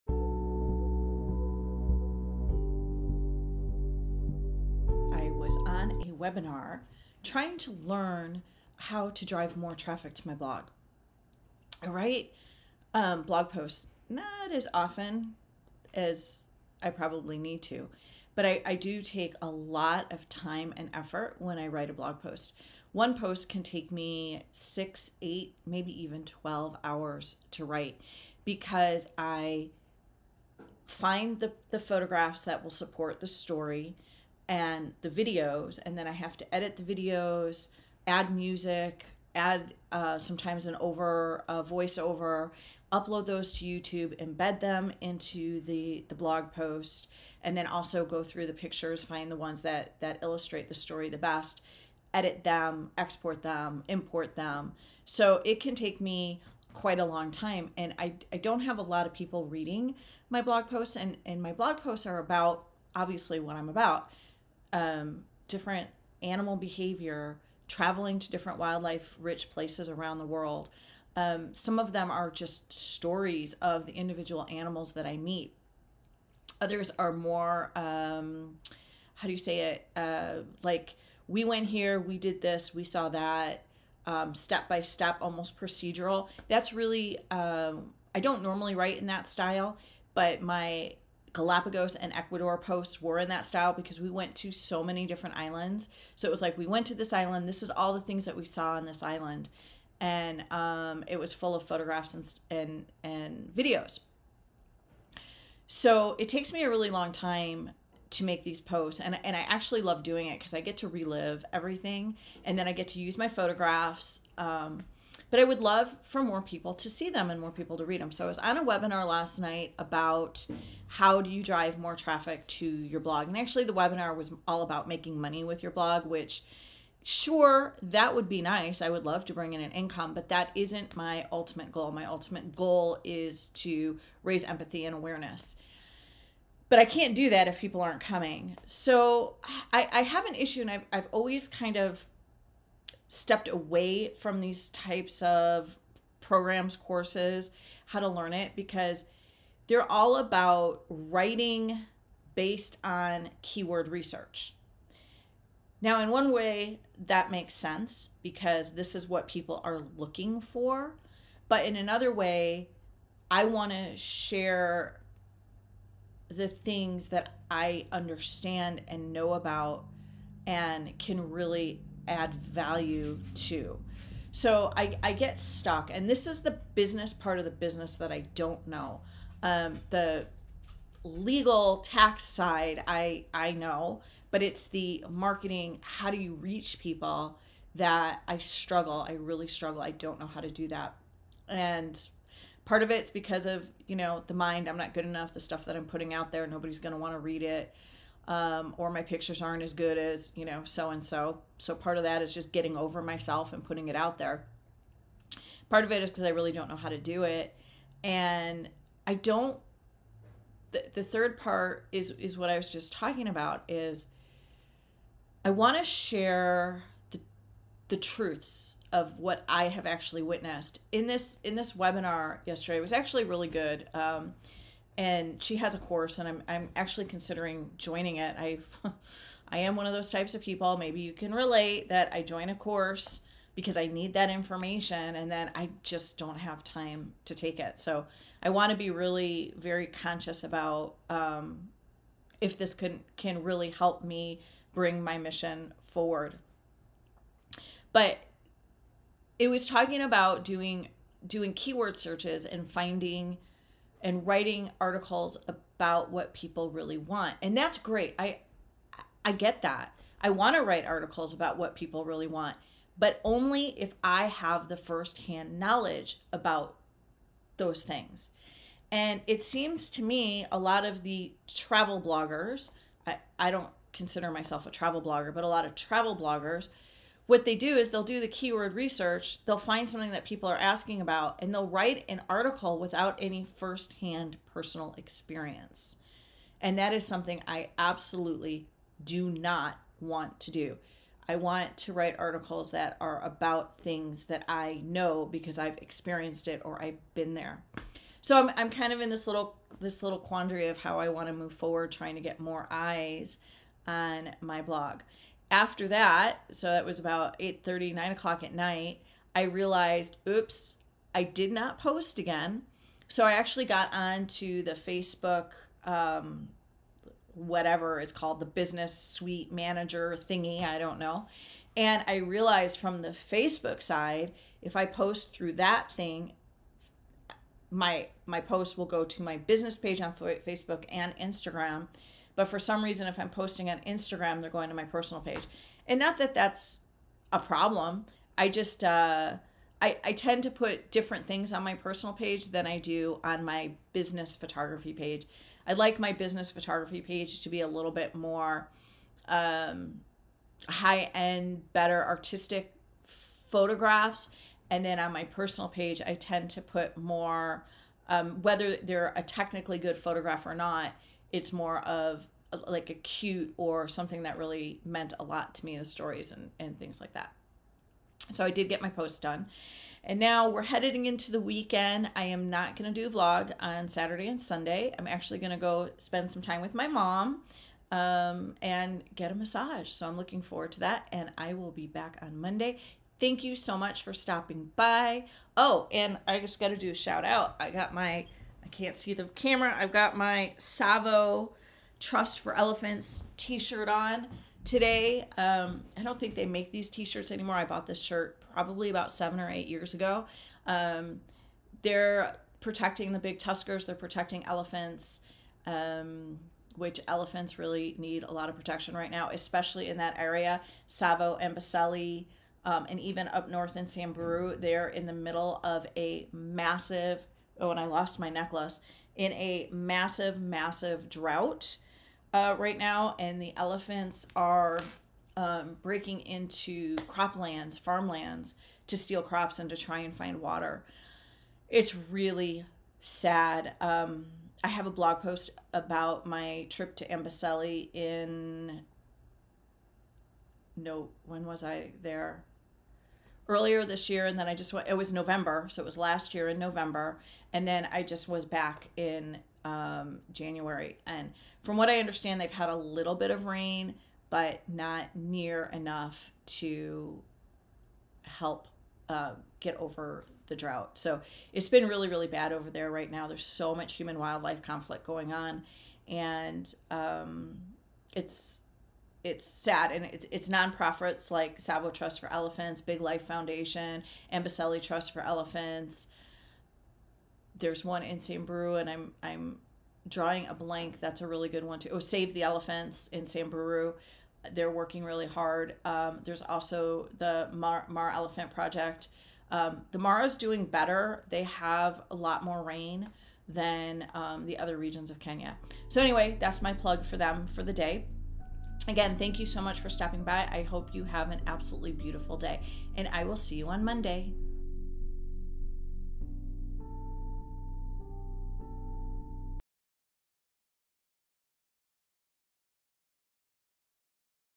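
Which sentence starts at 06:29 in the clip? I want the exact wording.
I've got my Tsavo Trust for Elephants t-shirt on today.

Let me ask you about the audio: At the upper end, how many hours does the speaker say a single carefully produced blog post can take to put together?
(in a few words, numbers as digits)
12 hours.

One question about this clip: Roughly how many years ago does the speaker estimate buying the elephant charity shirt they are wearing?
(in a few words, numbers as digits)
7 or 8 years.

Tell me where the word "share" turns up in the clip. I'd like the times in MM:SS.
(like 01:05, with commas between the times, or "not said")
02:43, 03:35.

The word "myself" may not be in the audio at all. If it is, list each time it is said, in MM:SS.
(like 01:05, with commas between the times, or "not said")
03:23, 04:34.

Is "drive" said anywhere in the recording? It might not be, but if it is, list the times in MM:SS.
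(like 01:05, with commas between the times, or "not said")
00:09, 02:01.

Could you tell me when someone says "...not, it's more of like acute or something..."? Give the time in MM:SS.
06:00.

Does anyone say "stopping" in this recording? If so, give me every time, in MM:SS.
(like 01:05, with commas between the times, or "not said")
06:24, 08:19.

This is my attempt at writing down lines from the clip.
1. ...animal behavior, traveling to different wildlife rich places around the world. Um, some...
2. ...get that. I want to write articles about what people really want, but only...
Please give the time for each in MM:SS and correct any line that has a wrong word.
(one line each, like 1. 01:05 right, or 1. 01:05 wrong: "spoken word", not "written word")
1. 01:06 right
2. 04:19 right.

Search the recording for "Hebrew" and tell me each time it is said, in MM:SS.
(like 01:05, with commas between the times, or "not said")
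not said.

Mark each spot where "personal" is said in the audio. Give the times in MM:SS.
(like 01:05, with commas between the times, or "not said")
04:44, 05:34, 05:41, 05:55.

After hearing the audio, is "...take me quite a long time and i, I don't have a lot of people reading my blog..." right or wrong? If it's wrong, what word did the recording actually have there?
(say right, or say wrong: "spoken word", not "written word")
right.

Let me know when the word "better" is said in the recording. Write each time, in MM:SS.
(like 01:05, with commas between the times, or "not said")
05:51, 08:10.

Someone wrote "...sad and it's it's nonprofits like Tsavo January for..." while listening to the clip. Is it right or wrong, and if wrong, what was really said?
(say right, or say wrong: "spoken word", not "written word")
wrong: "Trust", not "January".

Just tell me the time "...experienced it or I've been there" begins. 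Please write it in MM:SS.
04:55.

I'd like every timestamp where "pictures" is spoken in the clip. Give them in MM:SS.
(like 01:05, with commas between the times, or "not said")
00:48, 03:19.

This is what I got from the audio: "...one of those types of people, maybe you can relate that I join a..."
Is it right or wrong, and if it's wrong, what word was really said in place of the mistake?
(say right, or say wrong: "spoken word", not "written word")
right.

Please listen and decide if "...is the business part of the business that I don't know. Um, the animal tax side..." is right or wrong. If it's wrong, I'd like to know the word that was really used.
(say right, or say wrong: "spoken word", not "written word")
wrong: "legal", not "animal".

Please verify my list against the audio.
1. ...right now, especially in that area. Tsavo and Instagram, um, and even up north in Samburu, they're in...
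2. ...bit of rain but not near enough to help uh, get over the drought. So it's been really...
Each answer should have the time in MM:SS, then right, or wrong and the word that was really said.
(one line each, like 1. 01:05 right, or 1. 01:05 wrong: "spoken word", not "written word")
1. 06:48 wrong: "Amboseli", not "Instagram"
2. 07:33 right.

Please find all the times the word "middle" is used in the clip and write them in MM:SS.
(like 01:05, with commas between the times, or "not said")
06:55.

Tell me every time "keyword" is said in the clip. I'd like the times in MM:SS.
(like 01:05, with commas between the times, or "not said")
02:33, 04:11, 04:38.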